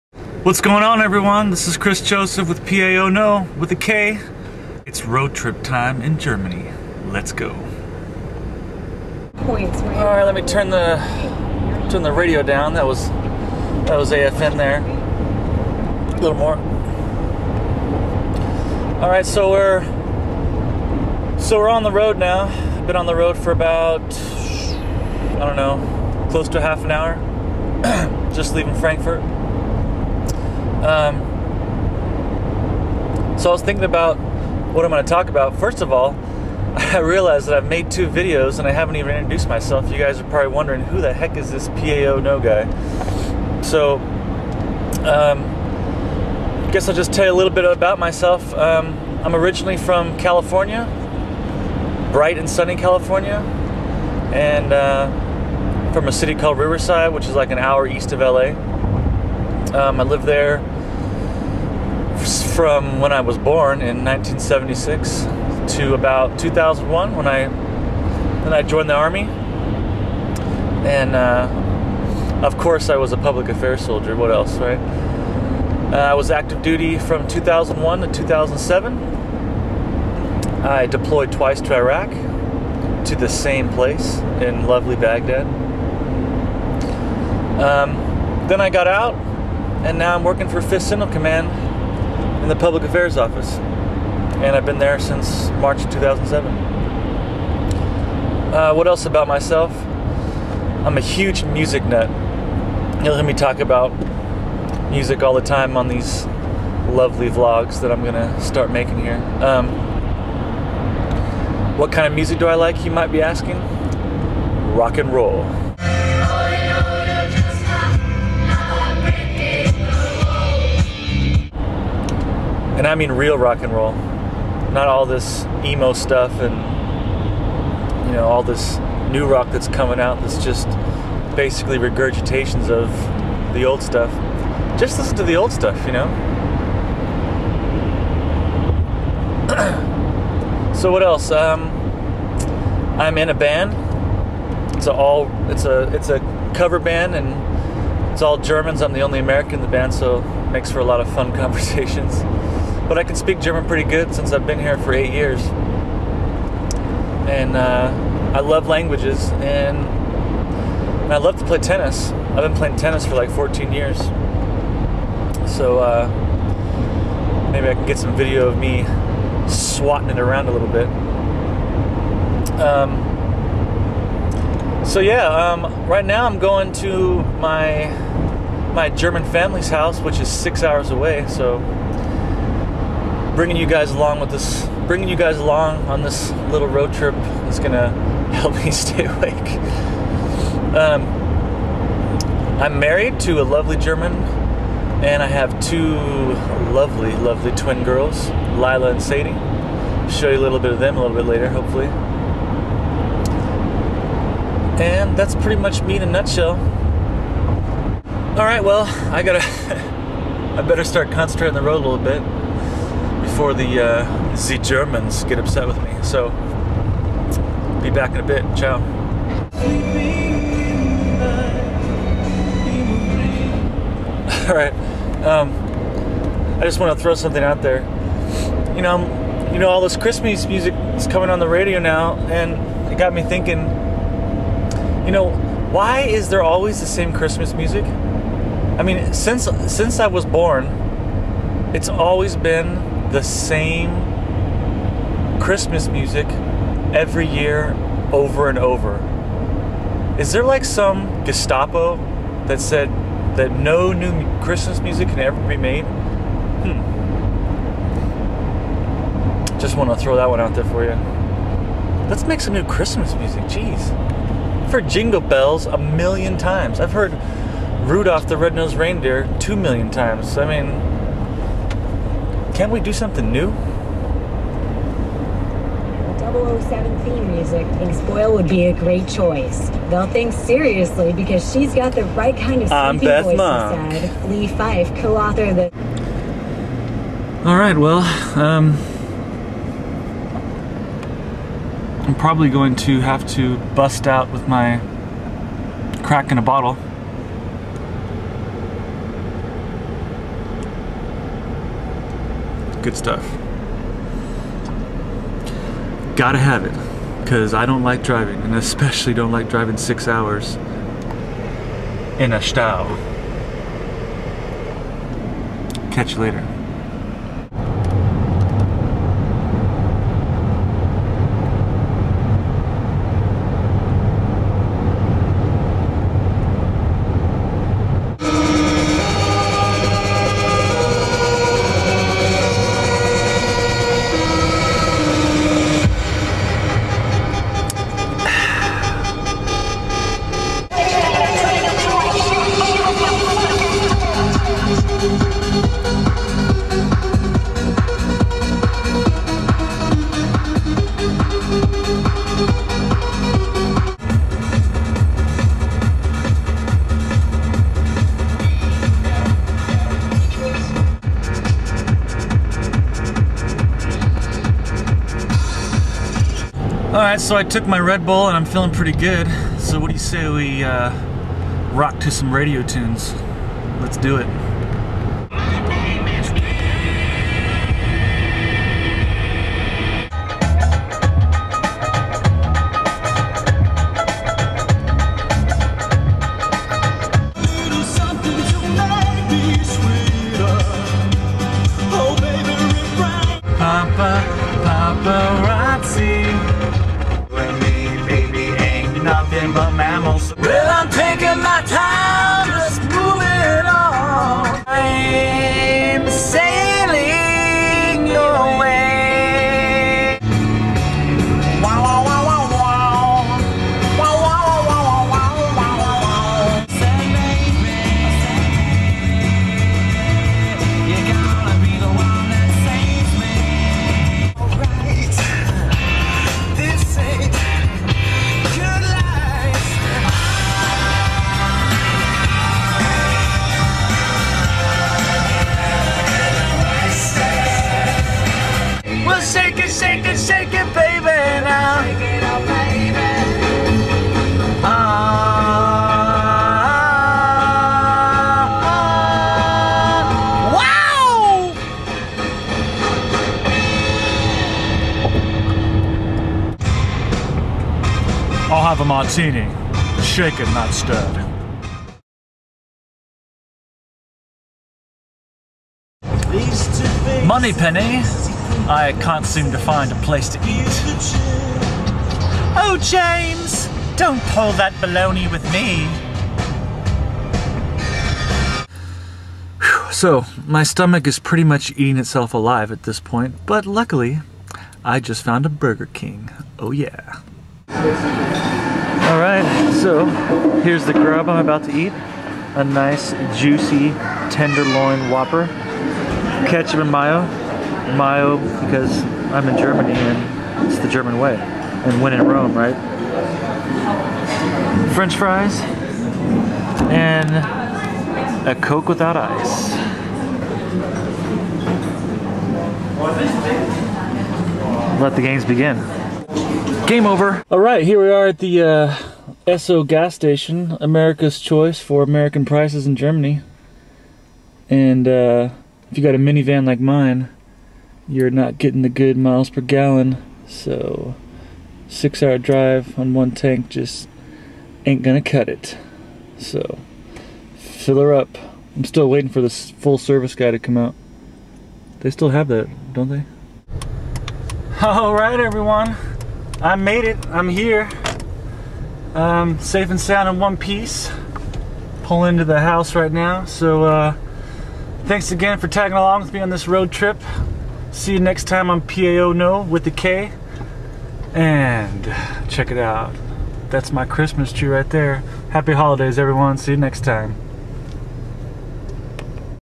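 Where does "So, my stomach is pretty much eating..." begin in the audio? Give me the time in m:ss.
7:59.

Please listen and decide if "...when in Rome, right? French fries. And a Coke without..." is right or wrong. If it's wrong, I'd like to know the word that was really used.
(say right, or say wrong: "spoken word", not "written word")
right.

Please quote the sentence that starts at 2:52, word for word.
Um, so yeah, um, right now I'm going to my my German family's house, which is six hours away.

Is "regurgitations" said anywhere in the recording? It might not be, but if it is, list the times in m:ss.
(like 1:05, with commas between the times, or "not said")
2:11.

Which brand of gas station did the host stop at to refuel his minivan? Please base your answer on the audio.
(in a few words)
Esso.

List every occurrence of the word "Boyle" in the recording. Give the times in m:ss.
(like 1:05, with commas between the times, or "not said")
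4:38.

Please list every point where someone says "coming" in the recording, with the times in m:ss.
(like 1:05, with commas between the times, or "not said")
2:09, 3:51.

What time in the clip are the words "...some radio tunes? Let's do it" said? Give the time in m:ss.
6:12.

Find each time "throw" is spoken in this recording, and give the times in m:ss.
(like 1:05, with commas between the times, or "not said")
3:47, 4:19.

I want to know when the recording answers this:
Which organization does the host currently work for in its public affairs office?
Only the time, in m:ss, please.
1:30.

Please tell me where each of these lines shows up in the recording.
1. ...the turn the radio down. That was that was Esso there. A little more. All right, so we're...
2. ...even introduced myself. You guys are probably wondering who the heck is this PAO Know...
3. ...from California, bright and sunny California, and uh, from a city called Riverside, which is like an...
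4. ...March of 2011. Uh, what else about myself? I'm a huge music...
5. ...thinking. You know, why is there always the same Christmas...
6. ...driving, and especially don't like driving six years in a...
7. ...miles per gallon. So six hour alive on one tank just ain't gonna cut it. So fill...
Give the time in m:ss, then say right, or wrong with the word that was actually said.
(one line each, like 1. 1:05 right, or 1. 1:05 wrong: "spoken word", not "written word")
1. 0:10 wrong: "AFN", not "Esso"
2. 0:38 right
3. 0:49 right
4. 1:35 wrong: "2007", not "2011"
5. 3:53 right
6. 5:08 wrong: "hours", not "years"
7. 8:49 wrong: "drive", not "alive".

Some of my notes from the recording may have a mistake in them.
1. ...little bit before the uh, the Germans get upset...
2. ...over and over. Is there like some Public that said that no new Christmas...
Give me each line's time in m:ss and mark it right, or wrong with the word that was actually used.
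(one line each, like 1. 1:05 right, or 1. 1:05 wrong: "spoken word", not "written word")
1. 3:31 right
2. 4:08 wrong: "Gestapo", not "Public".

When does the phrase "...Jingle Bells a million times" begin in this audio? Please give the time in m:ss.
4:24.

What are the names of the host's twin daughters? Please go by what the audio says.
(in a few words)
Lila and Sadie.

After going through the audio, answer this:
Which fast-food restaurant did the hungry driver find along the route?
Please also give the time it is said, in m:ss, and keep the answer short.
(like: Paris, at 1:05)
Burger King, at 8:05.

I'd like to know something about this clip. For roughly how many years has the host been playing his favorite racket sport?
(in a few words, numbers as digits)
14.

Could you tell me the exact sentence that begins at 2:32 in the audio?
But I can speak German pretty good since I've been here for eight years.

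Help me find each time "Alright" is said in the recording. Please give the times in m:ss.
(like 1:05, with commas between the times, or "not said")
6:07, 8:09.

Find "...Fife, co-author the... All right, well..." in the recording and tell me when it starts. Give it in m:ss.
4:44.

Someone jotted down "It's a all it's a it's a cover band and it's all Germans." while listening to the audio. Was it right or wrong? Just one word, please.
right.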